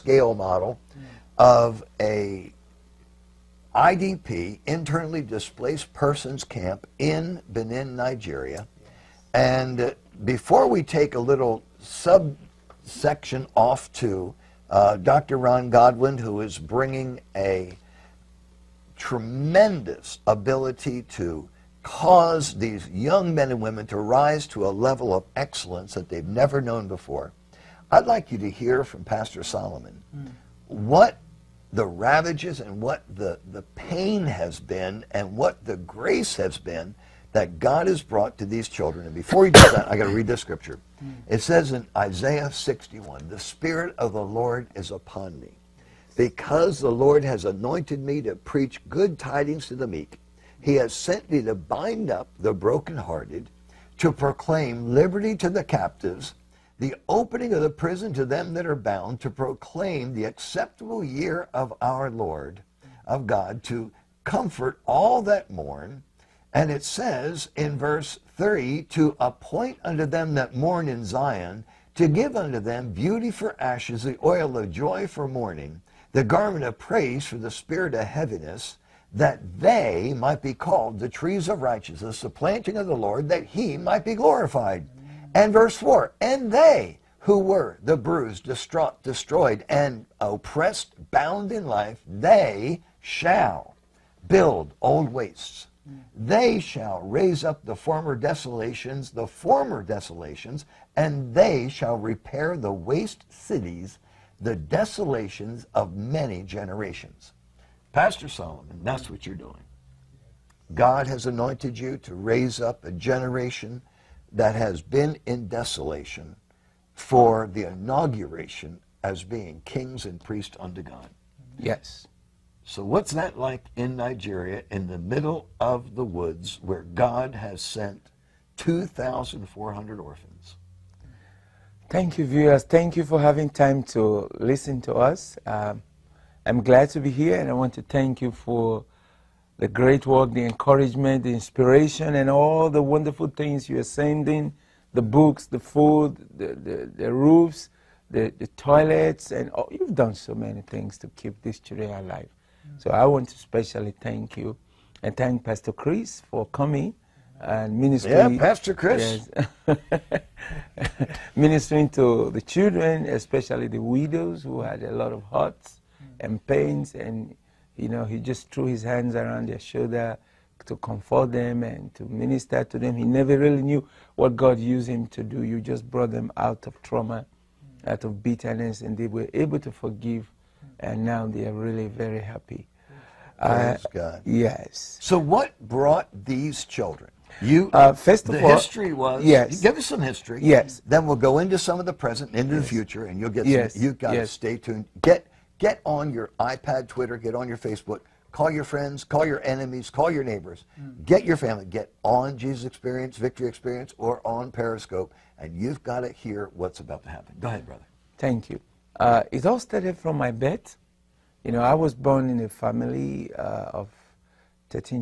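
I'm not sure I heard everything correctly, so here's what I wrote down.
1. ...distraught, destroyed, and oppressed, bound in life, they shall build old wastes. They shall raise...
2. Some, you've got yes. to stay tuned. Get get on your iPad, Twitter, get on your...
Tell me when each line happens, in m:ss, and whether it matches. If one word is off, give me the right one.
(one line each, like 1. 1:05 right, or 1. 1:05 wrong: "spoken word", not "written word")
1. 1:28 right
2. 3:13 right.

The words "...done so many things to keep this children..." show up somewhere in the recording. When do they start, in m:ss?
2:29.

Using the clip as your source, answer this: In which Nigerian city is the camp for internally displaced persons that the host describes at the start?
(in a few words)
Benin.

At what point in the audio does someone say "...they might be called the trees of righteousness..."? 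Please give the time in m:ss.
1:19.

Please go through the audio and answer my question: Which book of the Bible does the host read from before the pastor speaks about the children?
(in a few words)
Isaiah.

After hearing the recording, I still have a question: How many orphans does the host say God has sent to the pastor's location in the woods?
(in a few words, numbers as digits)
2,400.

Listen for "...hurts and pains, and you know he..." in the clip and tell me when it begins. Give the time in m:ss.
2:45.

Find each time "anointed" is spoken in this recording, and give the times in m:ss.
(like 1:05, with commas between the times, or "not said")
0:47, 1:51.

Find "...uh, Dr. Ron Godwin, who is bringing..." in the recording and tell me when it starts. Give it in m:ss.
0:14.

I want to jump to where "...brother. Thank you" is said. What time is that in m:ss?
3:27.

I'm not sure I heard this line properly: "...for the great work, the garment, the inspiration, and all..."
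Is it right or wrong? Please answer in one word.
wrong.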